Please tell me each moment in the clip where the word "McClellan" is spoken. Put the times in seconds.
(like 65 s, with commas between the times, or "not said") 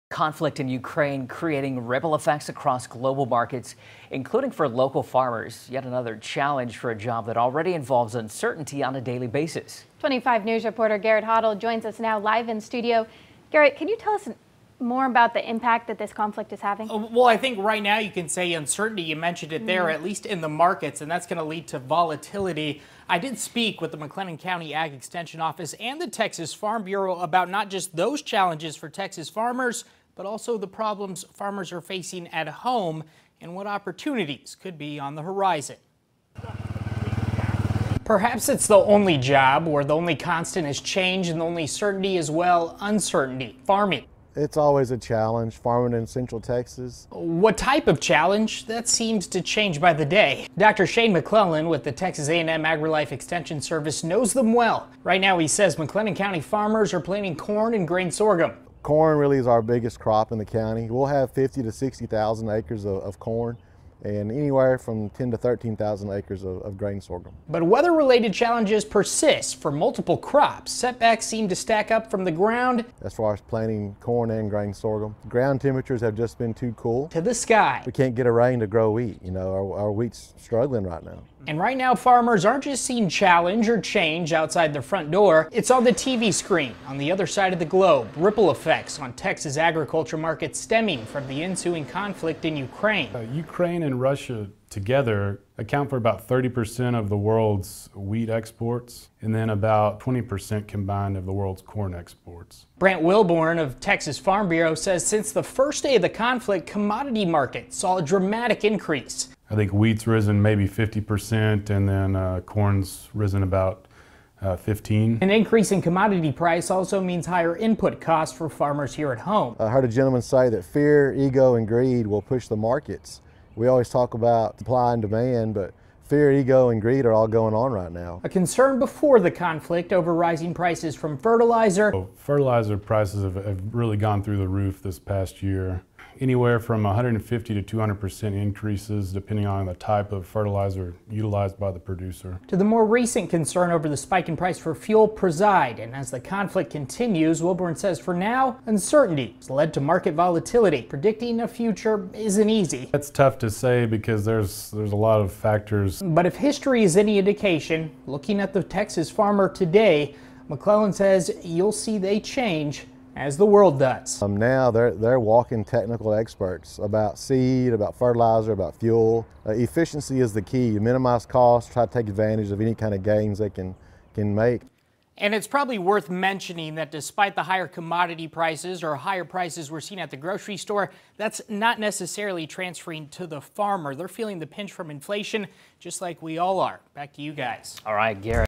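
51 s, 160 s.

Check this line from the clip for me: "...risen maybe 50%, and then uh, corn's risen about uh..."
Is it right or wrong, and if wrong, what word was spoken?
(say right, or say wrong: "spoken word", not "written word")
right.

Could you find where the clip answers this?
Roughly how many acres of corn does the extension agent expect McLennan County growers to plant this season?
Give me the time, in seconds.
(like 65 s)
61 s.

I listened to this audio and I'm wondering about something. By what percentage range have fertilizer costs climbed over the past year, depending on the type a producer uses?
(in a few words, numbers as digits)
150 to 200 percent.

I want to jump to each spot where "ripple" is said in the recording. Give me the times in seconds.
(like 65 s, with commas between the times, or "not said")
1 s, 88 s.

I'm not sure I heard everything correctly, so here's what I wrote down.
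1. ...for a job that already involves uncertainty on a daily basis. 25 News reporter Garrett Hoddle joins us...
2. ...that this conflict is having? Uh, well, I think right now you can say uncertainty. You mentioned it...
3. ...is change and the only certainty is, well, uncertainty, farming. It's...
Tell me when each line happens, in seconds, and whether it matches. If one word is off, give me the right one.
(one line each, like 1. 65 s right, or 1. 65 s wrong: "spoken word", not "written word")
1. 6 s right
2. 15 s right
3. 40 s right.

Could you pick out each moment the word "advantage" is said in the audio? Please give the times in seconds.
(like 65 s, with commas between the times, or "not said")
172 s.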